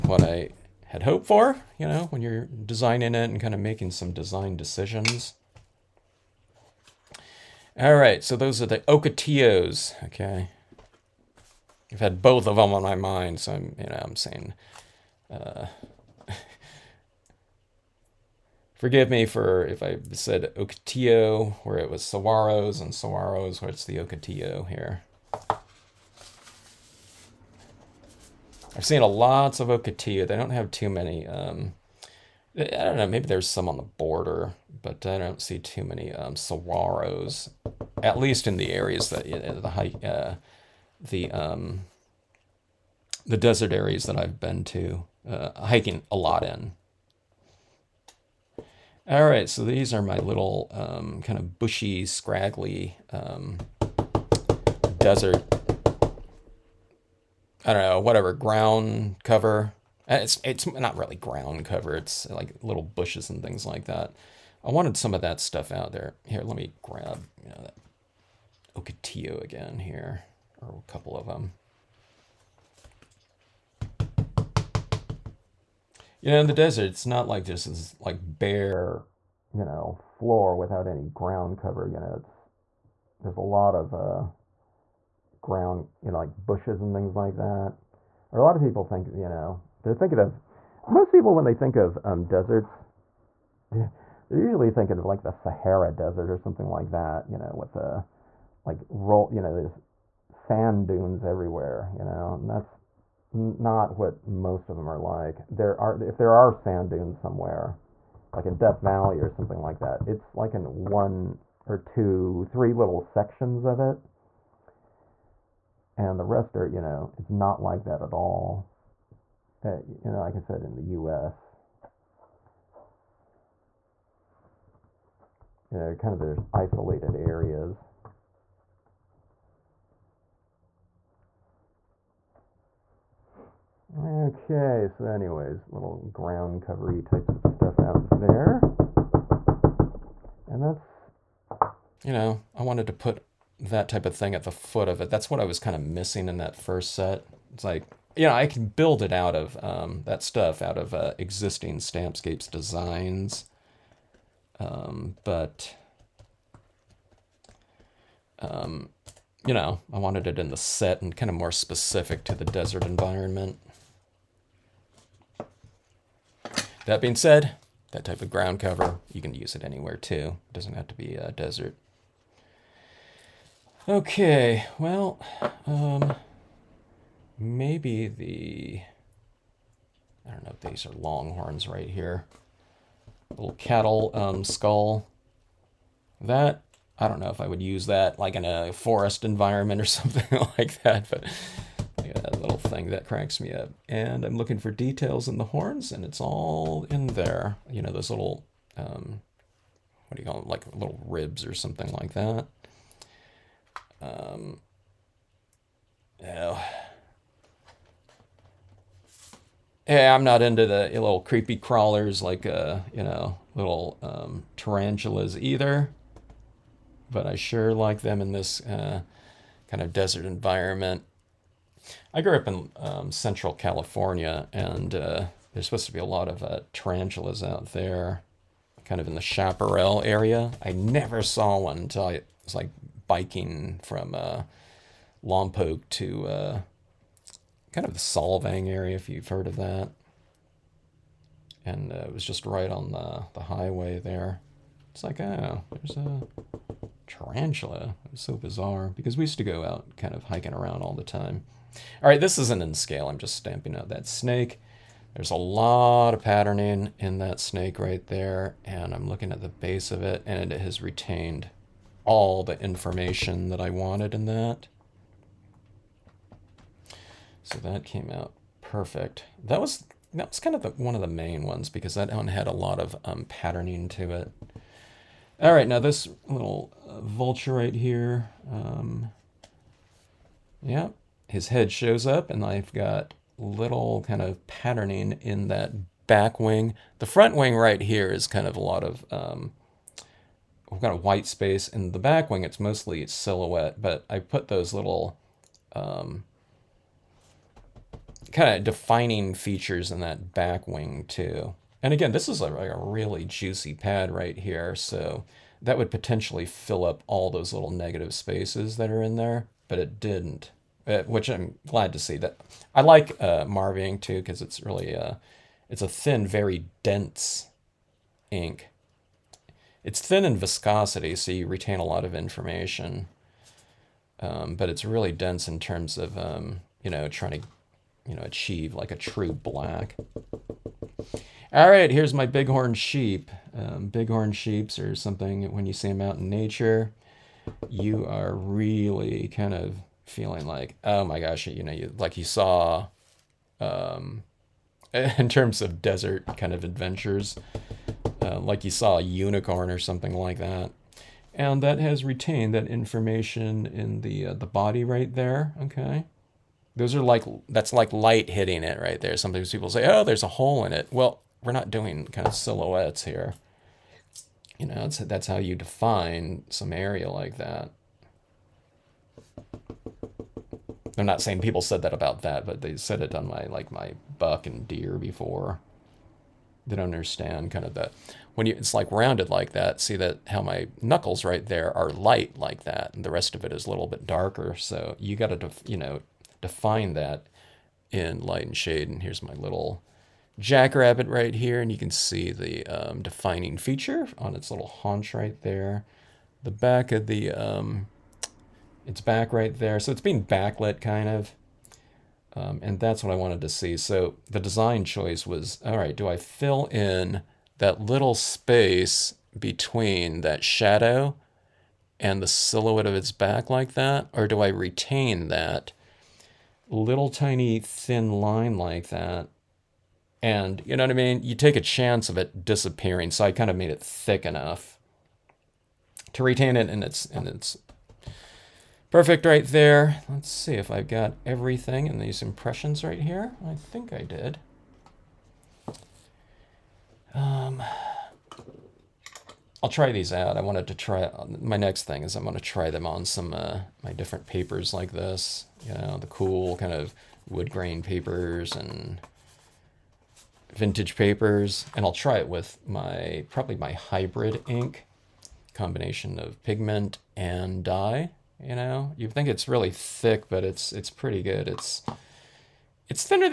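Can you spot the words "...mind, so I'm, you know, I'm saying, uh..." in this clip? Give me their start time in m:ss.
0:12.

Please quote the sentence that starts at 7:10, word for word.
Let's see if I've got everything in these impressions right here.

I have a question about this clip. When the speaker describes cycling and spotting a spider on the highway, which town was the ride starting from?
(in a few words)
Lompoc.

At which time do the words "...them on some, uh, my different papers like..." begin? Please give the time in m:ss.
7:22.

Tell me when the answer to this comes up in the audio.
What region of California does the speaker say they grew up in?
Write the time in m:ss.
3:43.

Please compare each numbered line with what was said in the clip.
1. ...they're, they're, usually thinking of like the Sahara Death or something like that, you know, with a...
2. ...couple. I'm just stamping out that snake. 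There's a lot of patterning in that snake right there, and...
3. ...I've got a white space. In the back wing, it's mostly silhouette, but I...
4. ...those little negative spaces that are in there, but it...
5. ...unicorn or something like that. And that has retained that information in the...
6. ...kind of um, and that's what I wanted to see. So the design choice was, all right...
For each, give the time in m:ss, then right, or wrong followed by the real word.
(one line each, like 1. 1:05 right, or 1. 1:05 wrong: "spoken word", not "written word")
1. 1:33 wrong: "Desert", not "Death"
2. 4:12 wrong: "scale", not "couple"
3. 4:50 right
4. 5:07 right
5. 5:49 right
6. 6:40 right.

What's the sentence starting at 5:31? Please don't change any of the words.
All right, here's my bighorn sheep.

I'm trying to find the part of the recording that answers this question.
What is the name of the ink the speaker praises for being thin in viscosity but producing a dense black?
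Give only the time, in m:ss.
5:13.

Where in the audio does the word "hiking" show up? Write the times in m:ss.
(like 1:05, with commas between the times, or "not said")
0:45, 4:10.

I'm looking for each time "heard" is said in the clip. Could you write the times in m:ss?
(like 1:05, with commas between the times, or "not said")
3:59.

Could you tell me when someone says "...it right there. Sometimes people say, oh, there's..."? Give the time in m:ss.
5:58.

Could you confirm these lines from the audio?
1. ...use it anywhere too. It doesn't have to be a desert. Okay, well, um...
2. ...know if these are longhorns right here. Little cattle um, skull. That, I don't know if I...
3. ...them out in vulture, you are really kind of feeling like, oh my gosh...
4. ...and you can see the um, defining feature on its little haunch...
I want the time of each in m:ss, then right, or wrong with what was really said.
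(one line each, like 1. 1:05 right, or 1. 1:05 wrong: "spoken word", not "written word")
1. 2:49 right
2. 3:00 right
3. 5:35 wrong: "nature", not "vulture"
4. 6:31 right.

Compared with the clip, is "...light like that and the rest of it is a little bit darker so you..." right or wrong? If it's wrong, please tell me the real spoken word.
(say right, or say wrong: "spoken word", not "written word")
right.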